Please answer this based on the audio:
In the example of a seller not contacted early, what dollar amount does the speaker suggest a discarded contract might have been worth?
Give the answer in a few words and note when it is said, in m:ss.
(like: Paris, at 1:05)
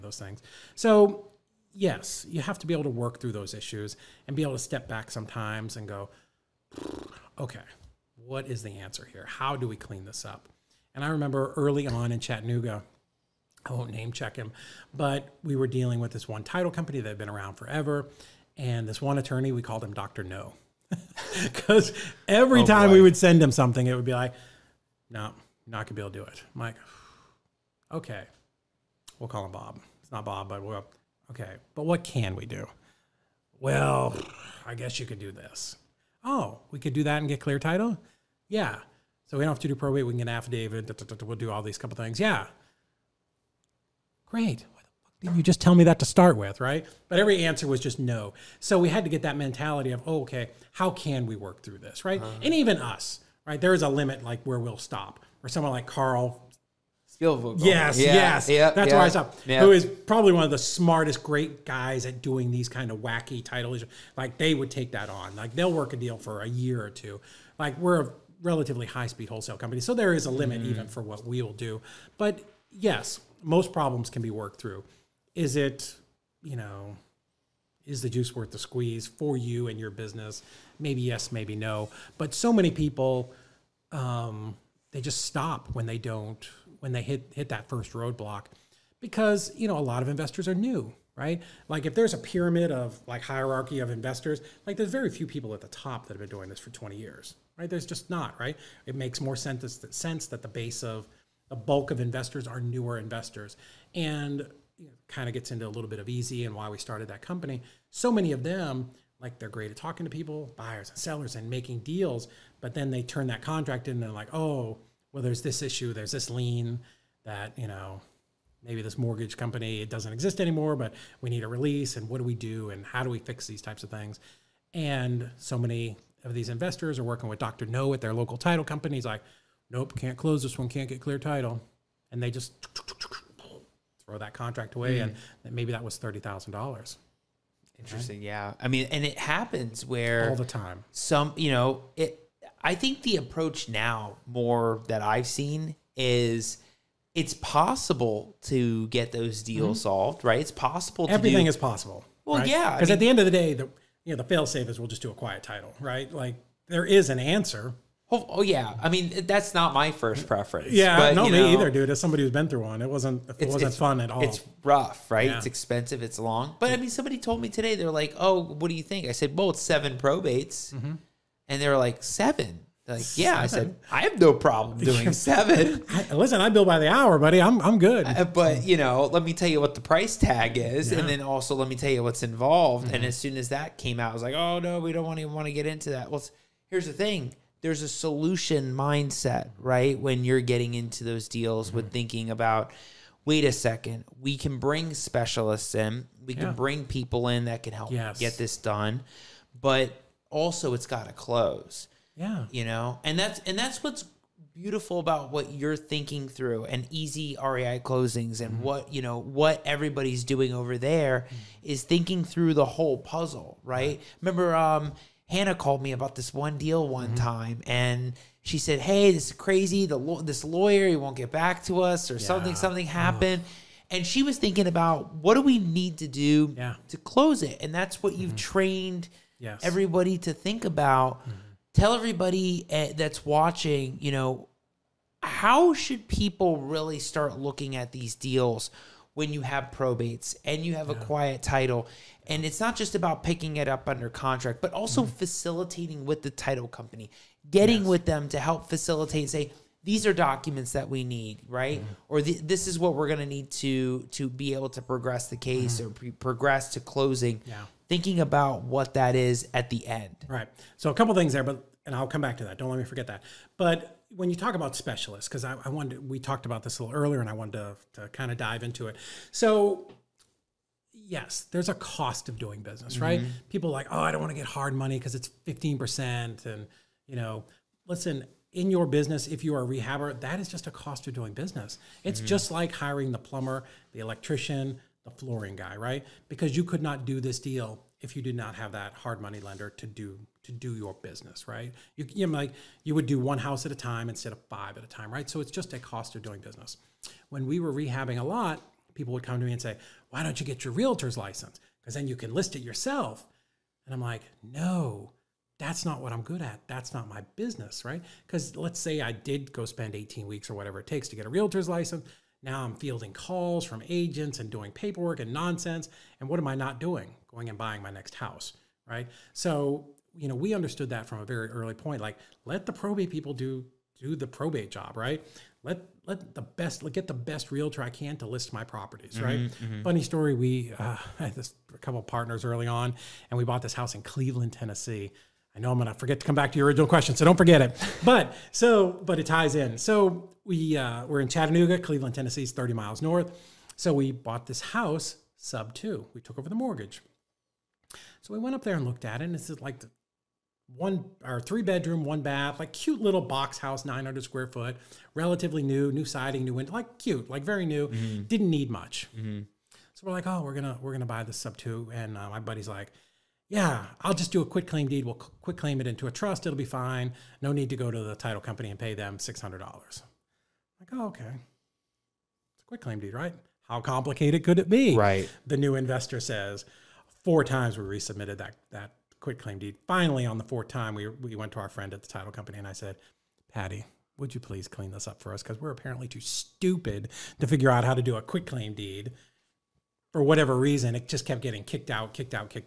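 $30,000, at 2:15.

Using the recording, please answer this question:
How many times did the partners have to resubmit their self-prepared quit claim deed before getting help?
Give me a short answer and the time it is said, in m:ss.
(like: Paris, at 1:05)
4, at 6:17.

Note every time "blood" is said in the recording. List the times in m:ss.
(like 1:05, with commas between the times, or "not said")
not said.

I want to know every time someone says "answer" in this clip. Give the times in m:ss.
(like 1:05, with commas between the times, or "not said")
0:08, 0:47, 2:37.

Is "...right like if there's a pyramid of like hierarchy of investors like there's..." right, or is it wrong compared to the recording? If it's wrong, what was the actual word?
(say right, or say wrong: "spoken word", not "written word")
right.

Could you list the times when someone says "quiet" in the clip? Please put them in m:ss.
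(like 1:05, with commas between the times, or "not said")
2:35, 4:01.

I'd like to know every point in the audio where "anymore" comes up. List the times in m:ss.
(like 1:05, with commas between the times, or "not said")
2:00.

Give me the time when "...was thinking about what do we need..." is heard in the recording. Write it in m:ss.
3:44.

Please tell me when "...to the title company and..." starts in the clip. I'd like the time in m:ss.
6:07.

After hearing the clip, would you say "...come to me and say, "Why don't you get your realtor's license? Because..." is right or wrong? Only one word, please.
right.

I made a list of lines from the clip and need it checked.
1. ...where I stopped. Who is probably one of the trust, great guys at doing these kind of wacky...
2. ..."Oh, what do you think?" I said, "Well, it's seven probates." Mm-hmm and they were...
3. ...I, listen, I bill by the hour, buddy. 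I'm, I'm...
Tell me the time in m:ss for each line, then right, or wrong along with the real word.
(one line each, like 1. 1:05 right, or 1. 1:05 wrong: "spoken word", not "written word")
1. 0:58 wrong: "smartest", not "trust"
2. 2:48 right
3. 2:55 right.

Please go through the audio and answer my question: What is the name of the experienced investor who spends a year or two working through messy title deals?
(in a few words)
Carl.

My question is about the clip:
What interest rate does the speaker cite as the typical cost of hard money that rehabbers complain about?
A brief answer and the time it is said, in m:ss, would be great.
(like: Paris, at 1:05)
15%, at 4:35.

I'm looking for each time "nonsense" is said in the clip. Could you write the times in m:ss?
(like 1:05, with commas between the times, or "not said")
5:15.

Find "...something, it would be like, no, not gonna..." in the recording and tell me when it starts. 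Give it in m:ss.
0:23.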